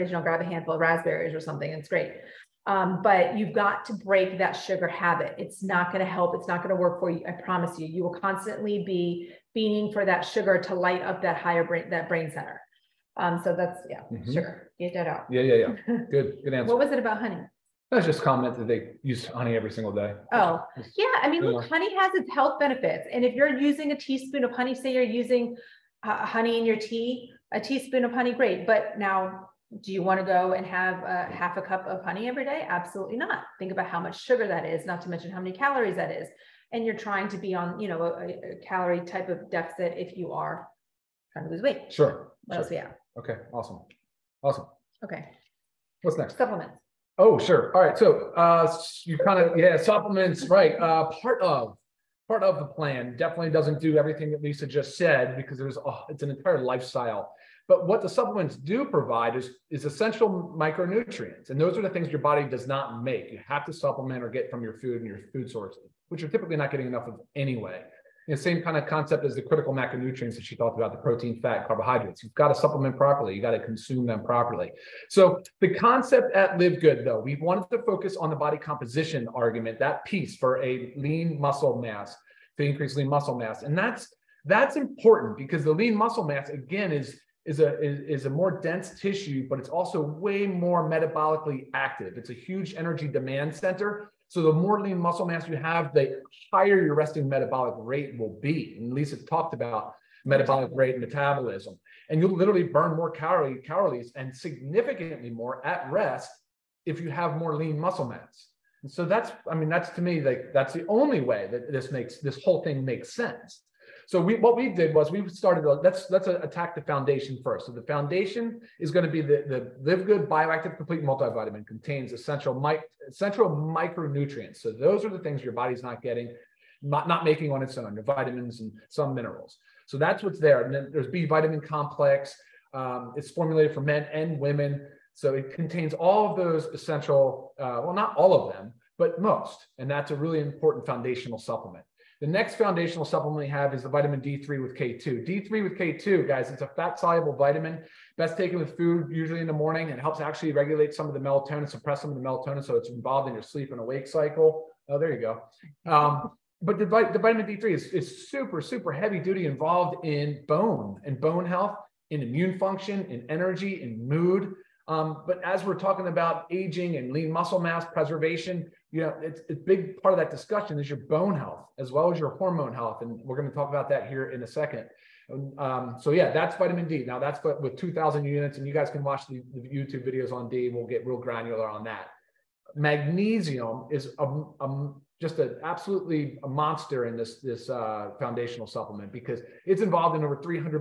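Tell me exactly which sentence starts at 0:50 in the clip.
Uh, part of part of the plan definitely doesn't do everything that Lisa just said because there's oh, it's an entire lifestyle.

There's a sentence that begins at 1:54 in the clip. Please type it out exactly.
So we, what we did was we started, let's, let's attack the foundation first.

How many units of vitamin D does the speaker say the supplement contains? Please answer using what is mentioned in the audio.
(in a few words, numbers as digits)
2000.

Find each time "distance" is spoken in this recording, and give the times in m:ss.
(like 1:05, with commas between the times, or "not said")
not said.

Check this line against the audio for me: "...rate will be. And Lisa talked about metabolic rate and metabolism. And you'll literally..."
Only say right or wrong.
right.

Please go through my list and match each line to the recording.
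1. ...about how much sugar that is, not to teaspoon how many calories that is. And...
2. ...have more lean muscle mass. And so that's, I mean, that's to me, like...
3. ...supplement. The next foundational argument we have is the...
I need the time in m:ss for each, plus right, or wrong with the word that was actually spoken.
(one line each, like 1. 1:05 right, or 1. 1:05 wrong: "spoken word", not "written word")
1. 0:33 wrong: "mention", not "teaspoon"
2. 1:47 right
3. 2:21 wrong: "supplement", not "argument".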